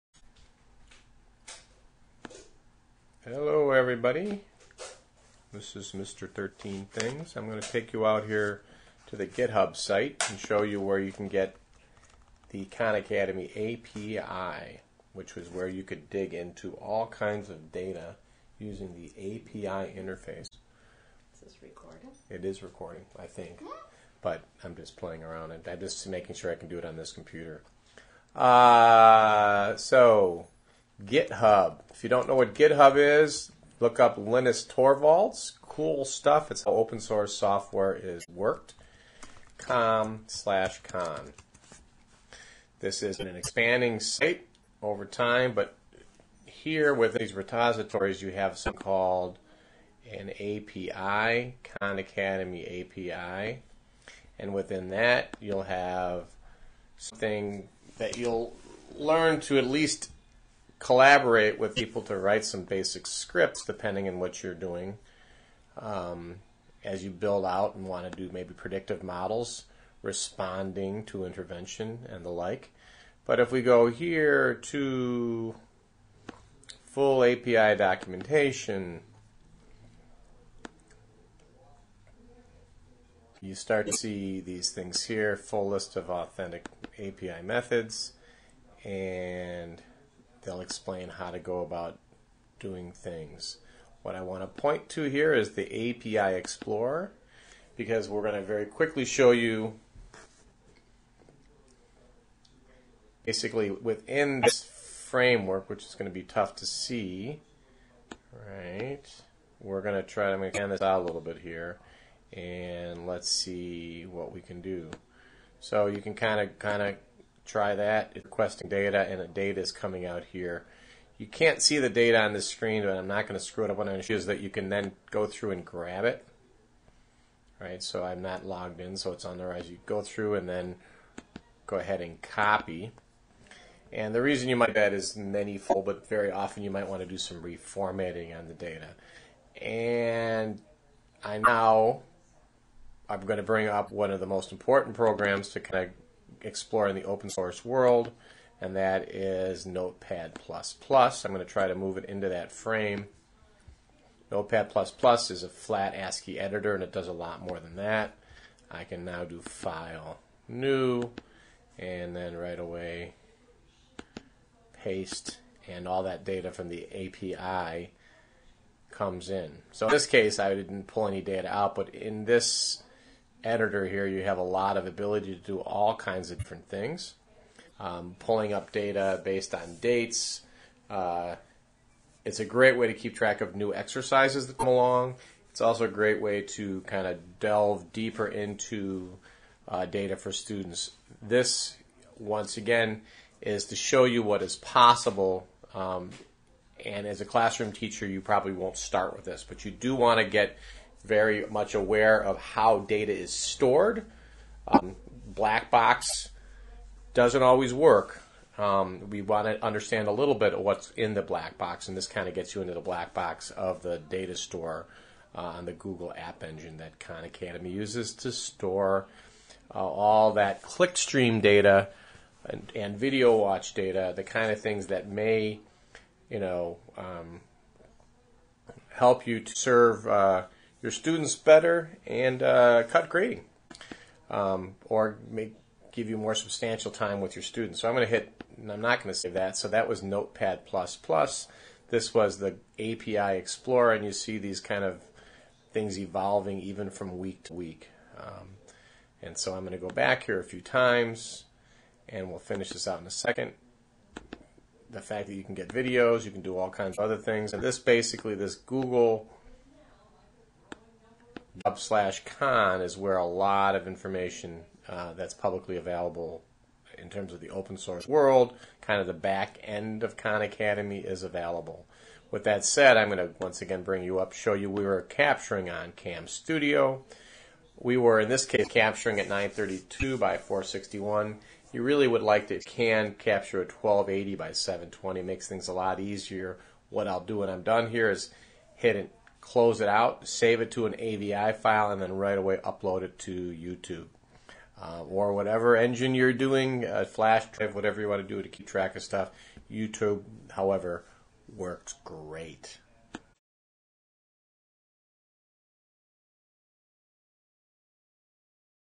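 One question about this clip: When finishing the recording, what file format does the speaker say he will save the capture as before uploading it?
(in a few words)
AVI.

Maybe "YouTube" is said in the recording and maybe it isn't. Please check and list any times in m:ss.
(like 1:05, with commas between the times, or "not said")
4:53, 4:59.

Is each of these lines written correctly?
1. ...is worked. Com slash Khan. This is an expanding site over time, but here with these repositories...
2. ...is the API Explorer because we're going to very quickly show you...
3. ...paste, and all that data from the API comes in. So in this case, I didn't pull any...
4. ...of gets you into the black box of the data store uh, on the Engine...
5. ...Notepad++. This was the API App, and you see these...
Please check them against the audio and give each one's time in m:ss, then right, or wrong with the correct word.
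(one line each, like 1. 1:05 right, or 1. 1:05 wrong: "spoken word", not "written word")
1. 0:37 right
2. 1:35 right
3. 2:44 right
4. 3:32 wrong: "Google", not "Engine"
5. 4:00 wrong: "Explorer", not "App".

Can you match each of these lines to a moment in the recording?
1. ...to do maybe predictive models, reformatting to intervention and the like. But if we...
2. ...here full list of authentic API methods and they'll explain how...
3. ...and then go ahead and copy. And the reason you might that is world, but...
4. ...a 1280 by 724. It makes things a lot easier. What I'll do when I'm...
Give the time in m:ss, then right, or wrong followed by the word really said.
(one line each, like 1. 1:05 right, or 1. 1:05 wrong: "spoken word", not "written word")
1. 1:08 wrong: "responding", not "reformatting"
2. 1:25 right
3. 2:10 wrong: "manyfold", not "world"
4. 4:43 wrong: "720", not "724".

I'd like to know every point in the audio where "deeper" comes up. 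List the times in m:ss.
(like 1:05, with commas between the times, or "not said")
3:07.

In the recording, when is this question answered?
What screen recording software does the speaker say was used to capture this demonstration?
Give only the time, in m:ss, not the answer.
4:35.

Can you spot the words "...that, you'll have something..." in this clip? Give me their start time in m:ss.
0:54.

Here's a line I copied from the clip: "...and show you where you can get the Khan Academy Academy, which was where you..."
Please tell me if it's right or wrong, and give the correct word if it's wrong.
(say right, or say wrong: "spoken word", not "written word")
wrong: "API", not "Academy".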